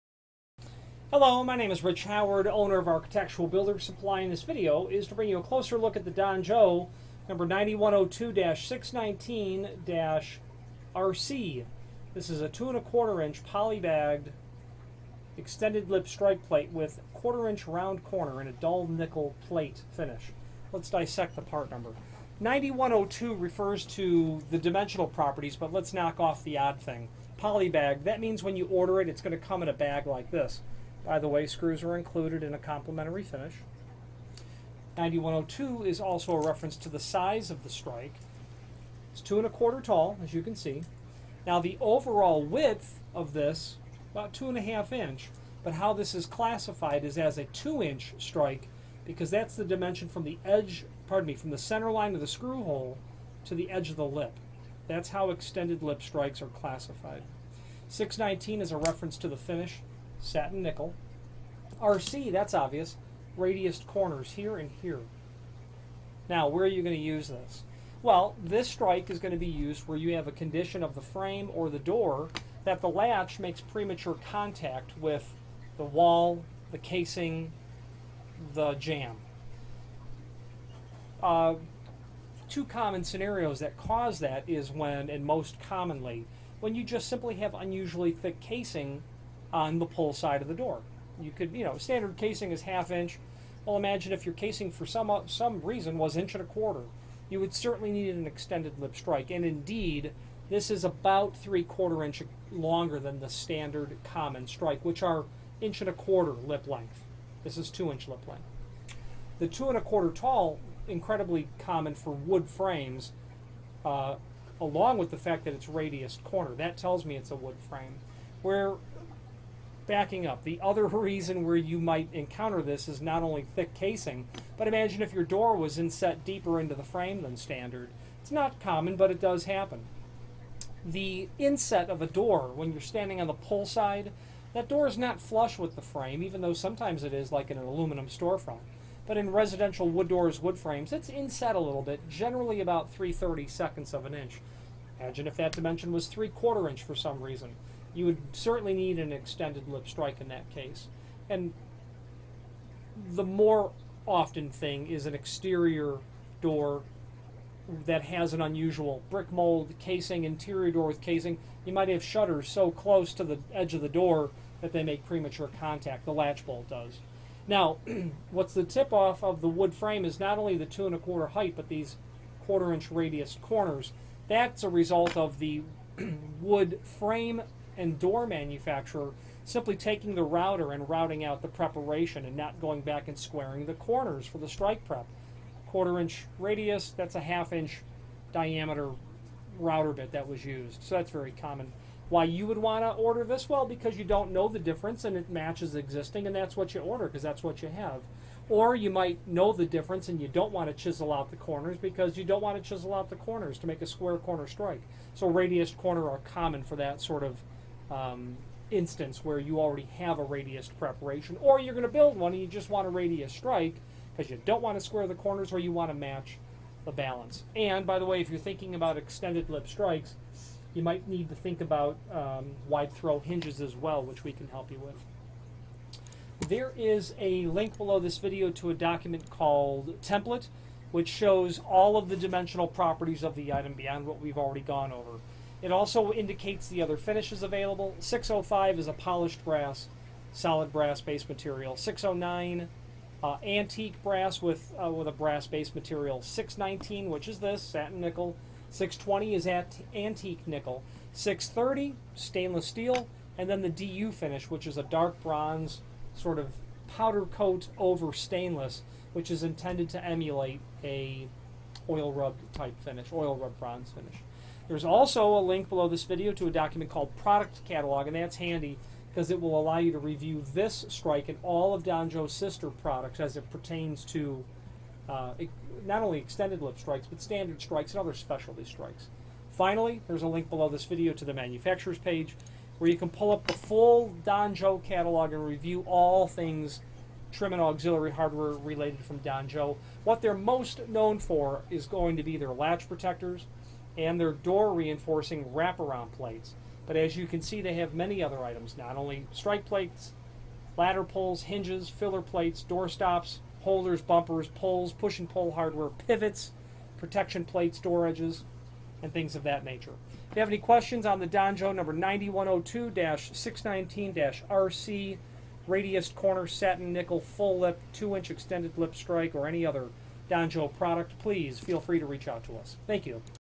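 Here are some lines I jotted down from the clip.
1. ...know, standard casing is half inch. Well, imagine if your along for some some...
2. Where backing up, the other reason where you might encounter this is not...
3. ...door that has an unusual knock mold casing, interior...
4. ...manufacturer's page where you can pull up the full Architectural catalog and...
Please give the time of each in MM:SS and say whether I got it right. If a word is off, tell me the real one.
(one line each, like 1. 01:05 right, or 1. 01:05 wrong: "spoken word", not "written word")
1. 01:31 wrong: "casing", not "along"
2. 01:58 right
3. 02:36 wrong: "brick", not "knock"
4. 04:41 wrong: "Donjo", not "Architectural".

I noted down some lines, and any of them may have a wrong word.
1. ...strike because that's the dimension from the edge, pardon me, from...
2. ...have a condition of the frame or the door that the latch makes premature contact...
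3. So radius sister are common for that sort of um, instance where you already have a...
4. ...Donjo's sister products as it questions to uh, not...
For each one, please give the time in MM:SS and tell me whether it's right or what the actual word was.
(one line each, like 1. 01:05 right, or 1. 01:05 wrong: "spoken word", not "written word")
1. 00:48 right
2. 01:10 right
3. 03:25 wrong: "corner", not "sister"
4. 04:31 wrong: "pertains", not "questions".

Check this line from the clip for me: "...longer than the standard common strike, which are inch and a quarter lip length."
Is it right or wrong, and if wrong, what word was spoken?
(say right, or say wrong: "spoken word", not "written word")
right.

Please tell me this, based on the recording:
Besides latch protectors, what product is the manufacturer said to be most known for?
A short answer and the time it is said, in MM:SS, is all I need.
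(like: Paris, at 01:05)
door reinforcing wraparound plates, at 04:54.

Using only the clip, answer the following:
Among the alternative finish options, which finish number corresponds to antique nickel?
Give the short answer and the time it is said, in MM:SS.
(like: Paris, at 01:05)
620, at 04:08.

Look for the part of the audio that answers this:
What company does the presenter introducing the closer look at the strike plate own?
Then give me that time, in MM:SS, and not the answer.
00:02.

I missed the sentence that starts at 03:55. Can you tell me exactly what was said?
It also indicates the other finishes available.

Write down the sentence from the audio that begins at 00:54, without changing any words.
That's how extended lip strikes are classified.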